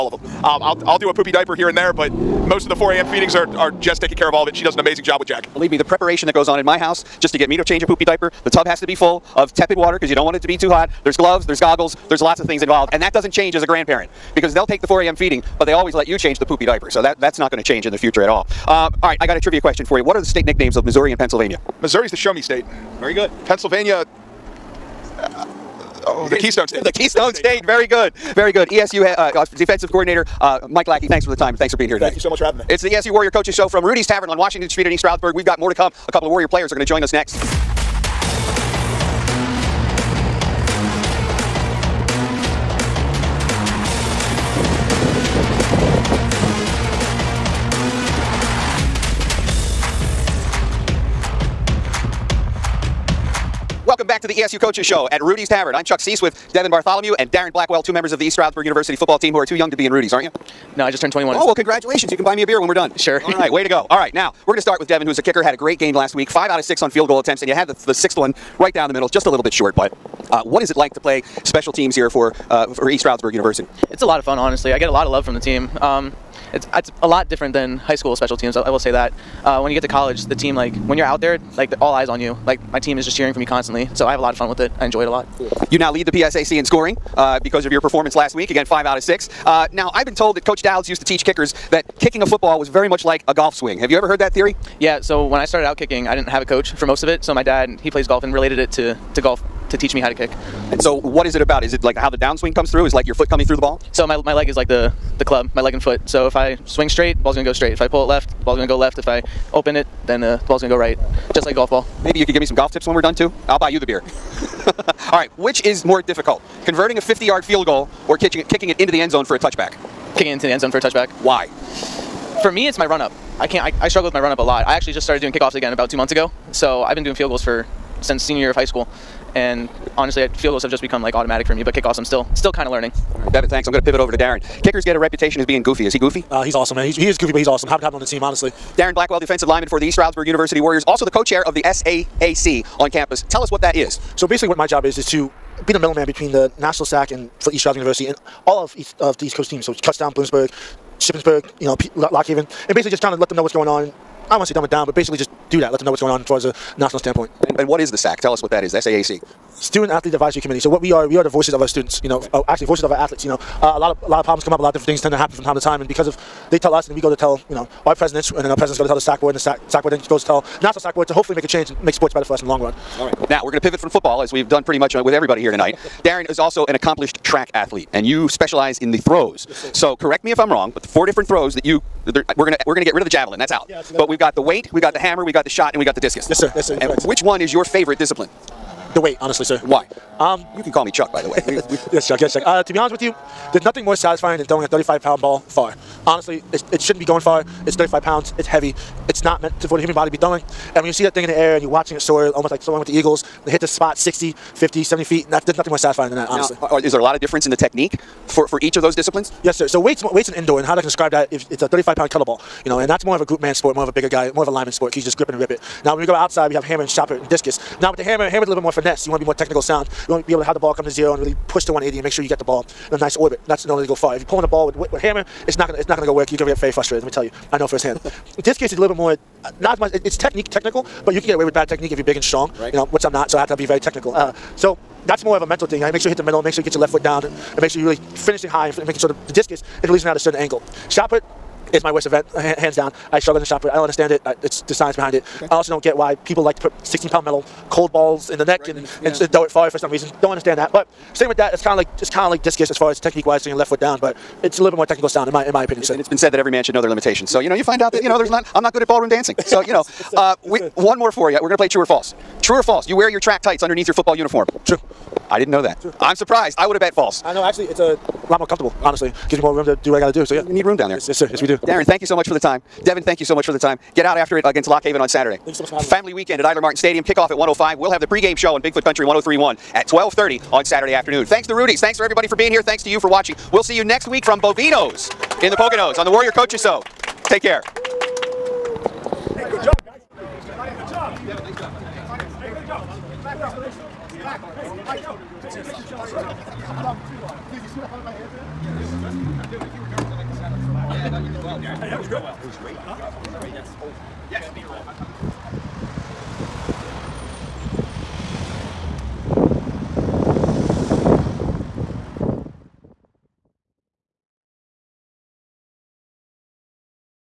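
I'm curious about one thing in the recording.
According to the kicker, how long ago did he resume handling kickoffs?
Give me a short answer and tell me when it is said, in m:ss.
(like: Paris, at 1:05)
2 months ago, at 2:05.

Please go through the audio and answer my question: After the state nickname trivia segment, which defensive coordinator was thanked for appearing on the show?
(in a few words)
Mike Lackey.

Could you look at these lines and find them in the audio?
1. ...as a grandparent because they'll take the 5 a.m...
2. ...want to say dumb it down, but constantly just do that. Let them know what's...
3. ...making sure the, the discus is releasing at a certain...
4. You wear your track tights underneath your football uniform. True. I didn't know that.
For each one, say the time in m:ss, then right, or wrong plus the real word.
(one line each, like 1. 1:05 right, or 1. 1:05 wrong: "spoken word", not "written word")
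1. 0:13 wrong: "4", not "5"
2. 2:34 wrong: "basically", not "constantly"
3. 3:58 right
4. 4:22 right.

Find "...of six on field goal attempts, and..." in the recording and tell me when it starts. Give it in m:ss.
1:06.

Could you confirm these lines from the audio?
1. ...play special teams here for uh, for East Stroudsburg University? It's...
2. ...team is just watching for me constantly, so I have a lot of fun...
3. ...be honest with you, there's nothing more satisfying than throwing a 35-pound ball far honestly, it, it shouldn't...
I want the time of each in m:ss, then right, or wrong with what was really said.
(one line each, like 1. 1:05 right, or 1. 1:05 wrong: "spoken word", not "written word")
1. 1:10 right
2. 1:22 wrong: "cheering", not "watching"
3. 3:12 right.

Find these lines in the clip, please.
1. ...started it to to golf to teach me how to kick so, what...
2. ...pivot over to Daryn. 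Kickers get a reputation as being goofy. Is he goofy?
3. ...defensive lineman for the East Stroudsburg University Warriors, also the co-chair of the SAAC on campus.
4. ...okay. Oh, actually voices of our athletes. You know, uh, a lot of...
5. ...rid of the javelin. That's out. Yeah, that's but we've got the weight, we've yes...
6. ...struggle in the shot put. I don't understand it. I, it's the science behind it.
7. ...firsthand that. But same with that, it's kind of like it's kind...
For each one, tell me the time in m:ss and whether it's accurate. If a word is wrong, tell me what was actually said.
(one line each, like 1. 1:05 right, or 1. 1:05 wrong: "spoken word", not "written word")
1. 1:38 wrong: "related", not "started"
2. 2:13 right
3. 2:19 right
4. 2:42 right
5. 3:02 right
6. 4:03 right
7. 4:10 wrong: "understand", not "firsthand".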